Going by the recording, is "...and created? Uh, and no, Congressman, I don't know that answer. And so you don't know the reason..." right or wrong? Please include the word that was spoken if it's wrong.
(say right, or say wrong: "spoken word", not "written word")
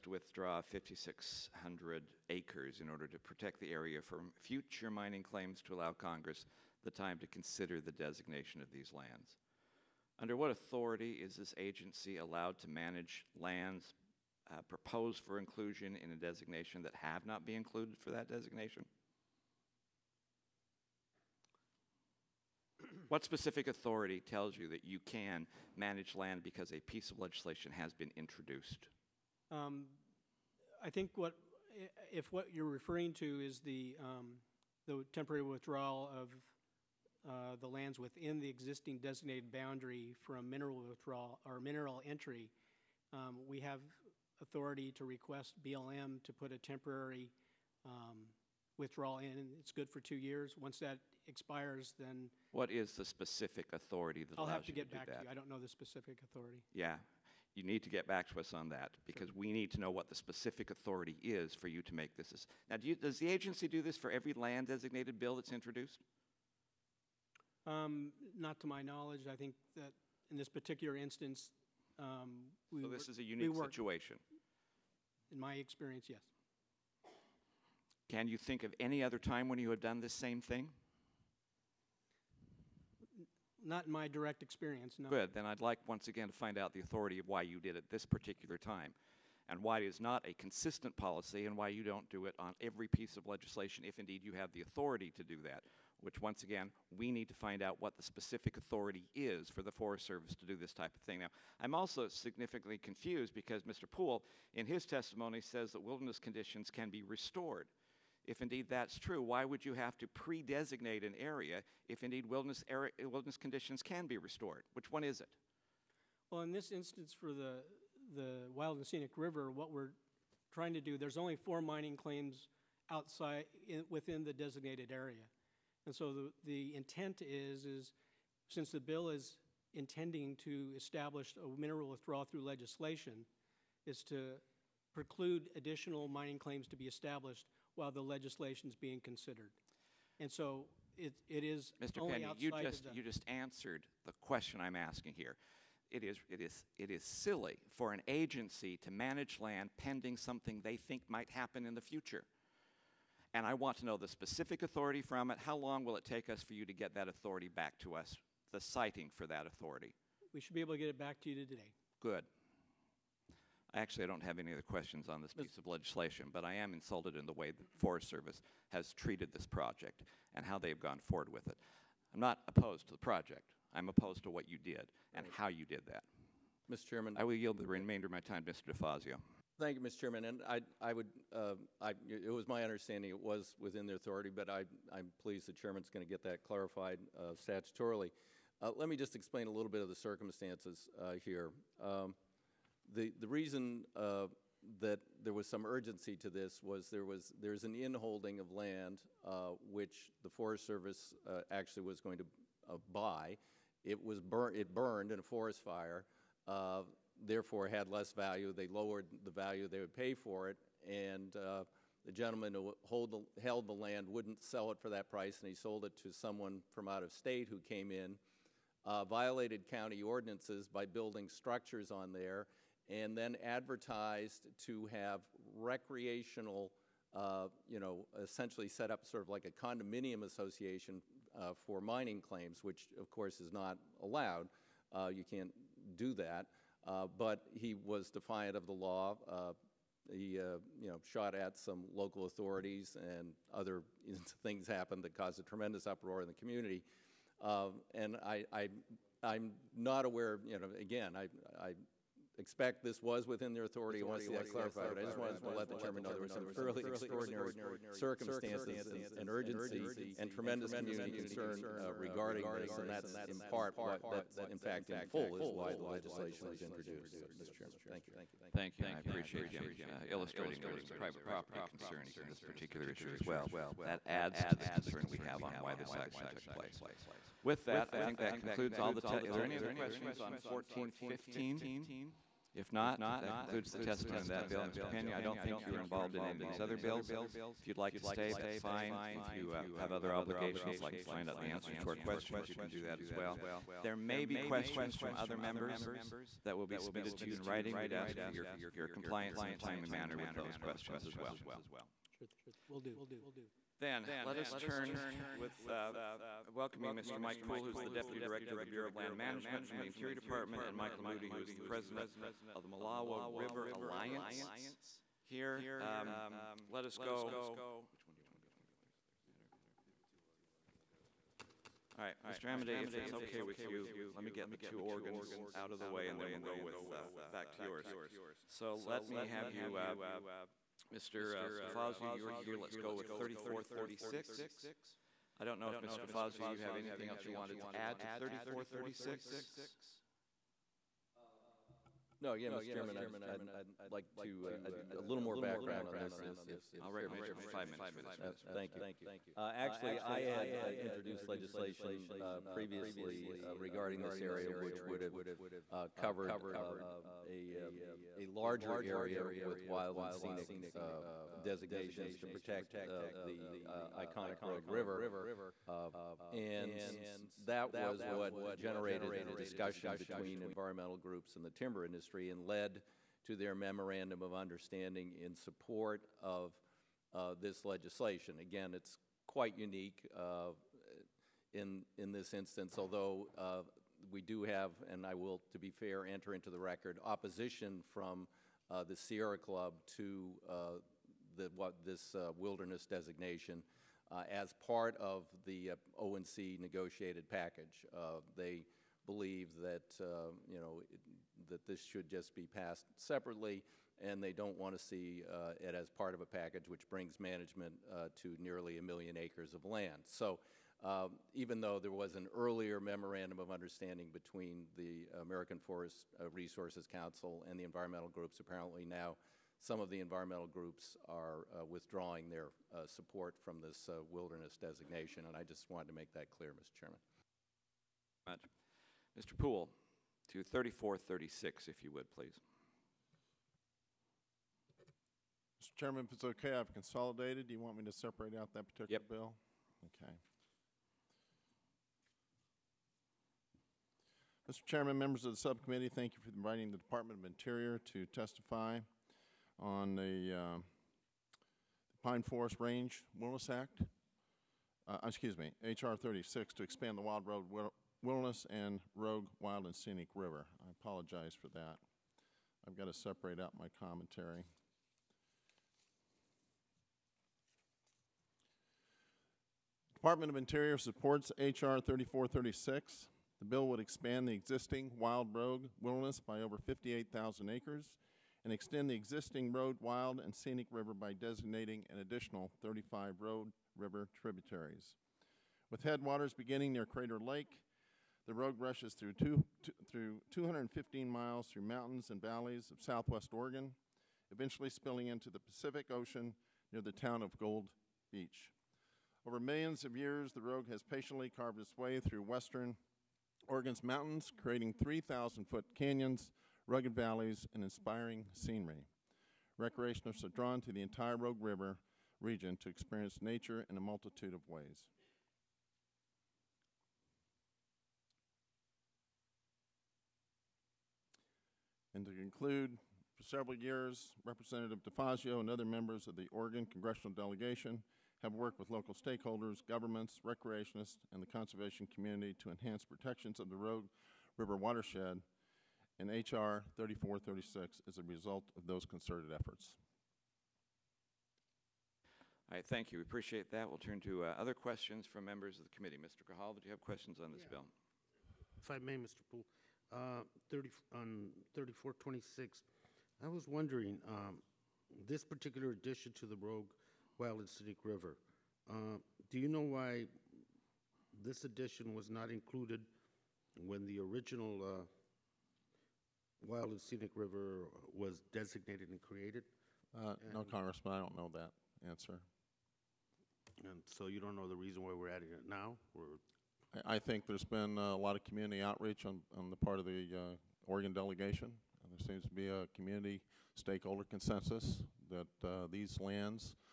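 right.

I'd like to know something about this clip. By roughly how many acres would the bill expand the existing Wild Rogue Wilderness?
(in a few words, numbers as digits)
58,000.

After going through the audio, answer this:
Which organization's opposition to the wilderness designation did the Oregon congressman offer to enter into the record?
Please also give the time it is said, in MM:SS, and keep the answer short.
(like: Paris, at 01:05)
Sierra Club, at 06:28.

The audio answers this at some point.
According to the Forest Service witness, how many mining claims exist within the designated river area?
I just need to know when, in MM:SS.
02:01.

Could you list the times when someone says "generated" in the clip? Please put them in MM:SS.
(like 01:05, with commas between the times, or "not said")
06:08.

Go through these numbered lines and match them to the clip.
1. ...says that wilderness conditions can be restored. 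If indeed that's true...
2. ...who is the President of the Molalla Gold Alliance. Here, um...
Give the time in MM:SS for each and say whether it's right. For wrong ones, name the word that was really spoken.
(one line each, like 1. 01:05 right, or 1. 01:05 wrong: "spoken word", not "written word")
1. 01:45 right
2. 05:11 wrong: "River", not "Gold".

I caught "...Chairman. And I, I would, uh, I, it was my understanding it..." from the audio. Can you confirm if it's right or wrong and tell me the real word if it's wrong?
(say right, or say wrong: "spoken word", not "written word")
right.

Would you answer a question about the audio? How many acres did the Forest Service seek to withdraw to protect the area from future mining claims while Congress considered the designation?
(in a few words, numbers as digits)
5,600.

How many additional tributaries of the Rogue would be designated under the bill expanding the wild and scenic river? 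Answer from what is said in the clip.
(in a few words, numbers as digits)
35.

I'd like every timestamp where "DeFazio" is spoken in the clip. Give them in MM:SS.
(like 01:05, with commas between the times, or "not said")
02:58, 05:31, 05:36, 08:44.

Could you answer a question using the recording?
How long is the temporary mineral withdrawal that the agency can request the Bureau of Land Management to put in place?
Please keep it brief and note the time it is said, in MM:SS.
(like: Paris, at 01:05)
2 years, at 00:49.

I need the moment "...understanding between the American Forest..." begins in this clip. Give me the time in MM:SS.
06:53.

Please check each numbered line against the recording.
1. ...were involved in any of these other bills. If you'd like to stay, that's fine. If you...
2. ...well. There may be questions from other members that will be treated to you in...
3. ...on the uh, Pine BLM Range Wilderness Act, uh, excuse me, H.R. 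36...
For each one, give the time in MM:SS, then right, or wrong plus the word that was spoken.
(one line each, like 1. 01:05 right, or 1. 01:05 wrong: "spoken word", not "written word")
1. 04:45 right
2. 04:53 wrong: "submitted", not "treated"
3. 07:29 wrong: "Forest", not "BLM".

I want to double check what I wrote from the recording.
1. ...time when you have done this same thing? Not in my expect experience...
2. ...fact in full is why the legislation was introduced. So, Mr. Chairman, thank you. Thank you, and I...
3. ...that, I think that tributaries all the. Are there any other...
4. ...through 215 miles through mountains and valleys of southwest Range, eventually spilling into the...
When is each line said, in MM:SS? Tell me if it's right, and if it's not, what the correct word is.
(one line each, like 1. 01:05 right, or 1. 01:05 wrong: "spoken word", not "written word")
1. 01:19 wrong: "direct", not "expect"
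2. 04:24 right
3. 04:37 wrong: "concludes", not "tributaries"
4. 08:09 wrong: "Oregon", not "Range".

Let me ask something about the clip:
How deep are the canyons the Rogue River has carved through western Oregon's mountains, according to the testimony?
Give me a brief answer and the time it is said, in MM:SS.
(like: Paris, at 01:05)
3,000 feet, at 08:24.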